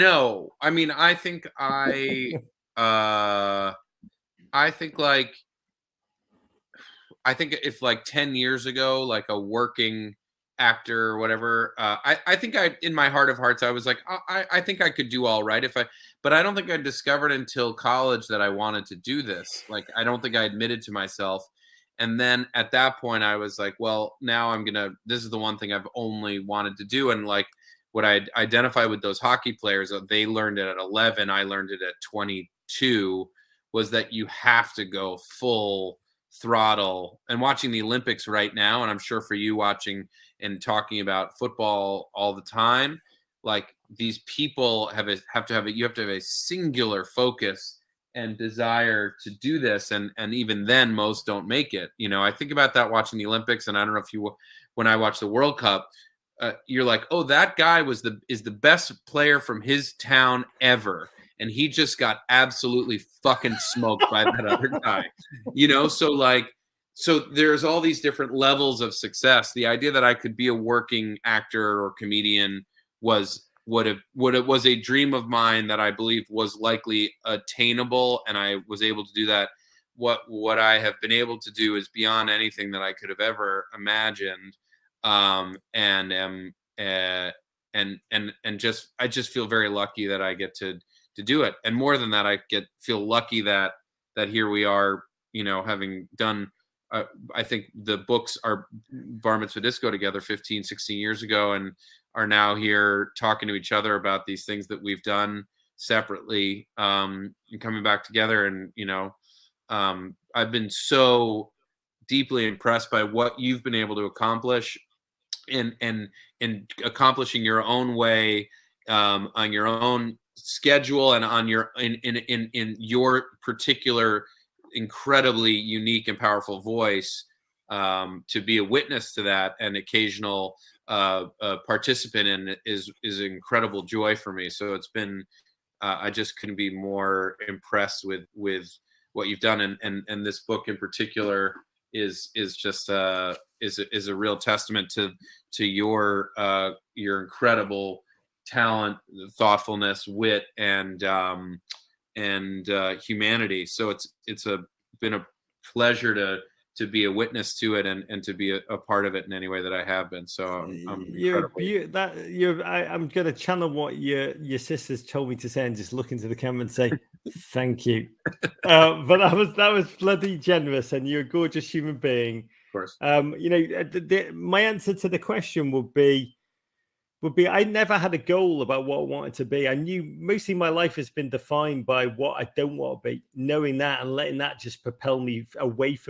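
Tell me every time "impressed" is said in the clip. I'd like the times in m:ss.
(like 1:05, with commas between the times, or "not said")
1:52, 2:17.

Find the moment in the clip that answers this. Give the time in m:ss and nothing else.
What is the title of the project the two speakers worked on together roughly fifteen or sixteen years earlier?
1:38.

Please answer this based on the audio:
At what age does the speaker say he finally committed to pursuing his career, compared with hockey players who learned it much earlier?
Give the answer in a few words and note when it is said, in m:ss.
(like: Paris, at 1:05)
22, at 0:32.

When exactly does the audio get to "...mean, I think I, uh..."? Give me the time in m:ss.
0:00.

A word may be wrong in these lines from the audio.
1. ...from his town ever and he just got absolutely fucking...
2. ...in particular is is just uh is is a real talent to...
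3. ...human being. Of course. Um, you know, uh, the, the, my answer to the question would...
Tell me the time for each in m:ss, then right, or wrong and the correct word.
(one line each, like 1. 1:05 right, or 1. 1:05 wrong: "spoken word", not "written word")
1. 0:59 right
2. 2:20 wrong: "testament", not "talent"
3. 2:51 right.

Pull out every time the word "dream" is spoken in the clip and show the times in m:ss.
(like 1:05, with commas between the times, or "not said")
1:14.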